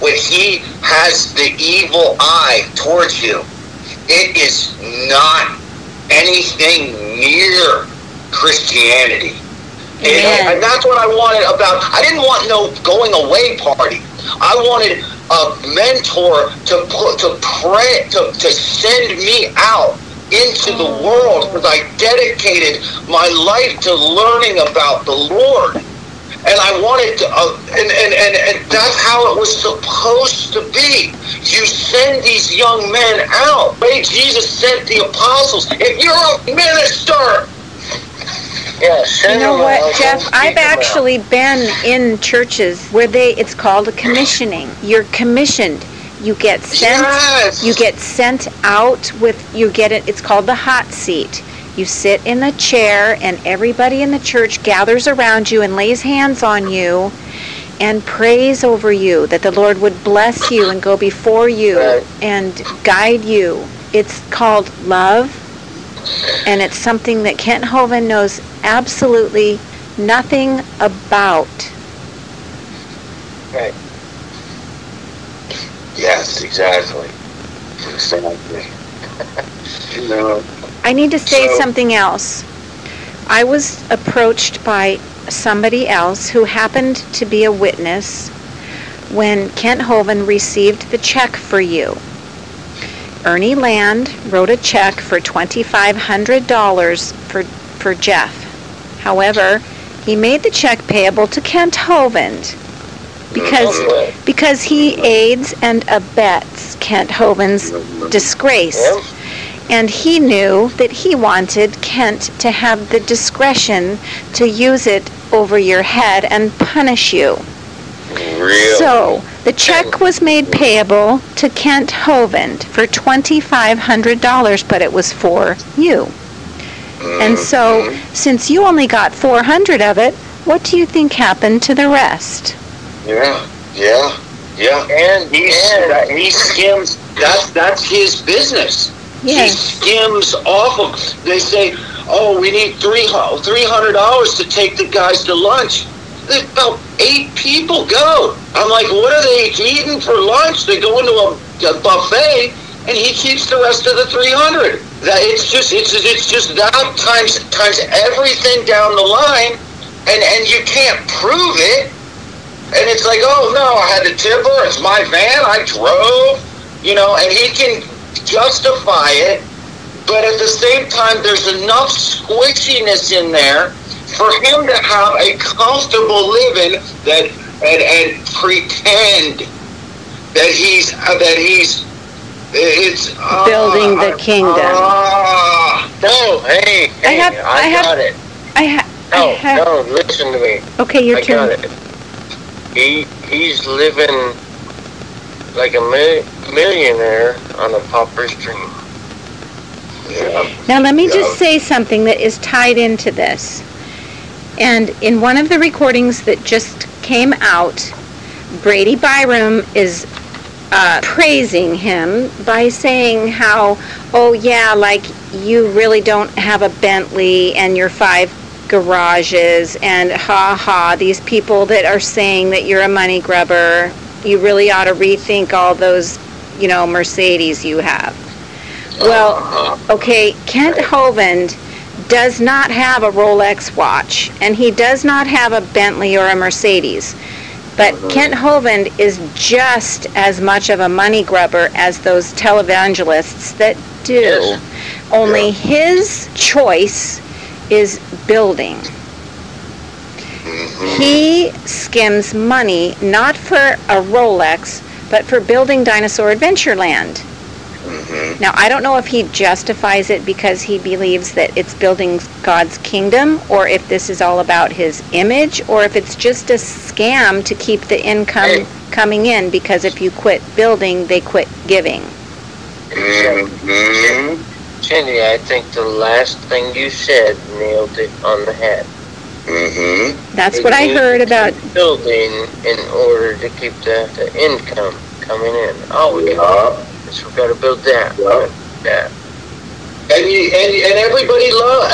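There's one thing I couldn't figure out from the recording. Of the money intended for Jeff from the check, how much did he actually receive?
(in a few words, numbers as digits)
400.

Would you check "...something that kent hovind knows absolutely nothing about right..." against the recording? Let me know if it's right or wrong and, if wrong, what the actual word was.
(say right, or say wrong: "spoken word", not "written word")
right.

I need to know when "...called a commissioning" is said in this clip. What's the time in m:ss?
0:43.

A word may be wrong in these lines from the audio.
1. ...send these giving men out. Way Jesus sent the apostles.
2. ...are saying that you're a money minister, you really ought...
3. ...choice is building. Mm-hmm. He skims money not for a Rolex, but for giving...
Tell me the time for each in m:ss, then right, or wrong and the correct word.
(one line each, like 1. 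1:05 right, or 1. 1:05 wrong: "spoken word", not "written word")
1. 0:31 wrong: "young", not "giving"
2. 3:41 wrong: "grubber", not "minister"
3. 4:06 wrong: "building", not "giving".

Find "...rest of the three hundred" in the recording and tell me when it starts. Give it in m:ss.
2:33.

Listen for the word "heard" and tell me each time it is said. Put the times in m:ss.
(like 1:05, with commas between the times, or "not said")
4:40.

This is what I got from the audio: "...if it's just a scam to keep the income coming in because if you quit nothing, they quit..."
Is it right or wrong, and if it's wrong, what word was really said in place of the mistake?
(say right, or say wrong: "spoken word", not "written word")
wrong: "building", not "nothing".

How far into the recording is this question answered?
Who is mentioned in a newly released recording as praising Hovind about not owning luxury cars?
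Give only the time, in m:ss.
3:28.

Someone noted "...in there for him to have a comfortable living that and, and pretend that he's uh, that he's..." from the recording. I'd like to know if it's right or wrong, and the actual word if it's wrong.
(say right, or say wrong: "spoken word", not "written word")
right.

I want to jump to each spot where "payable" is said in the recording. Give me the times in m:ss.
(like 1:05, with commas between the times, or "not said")
1:40, 2:00.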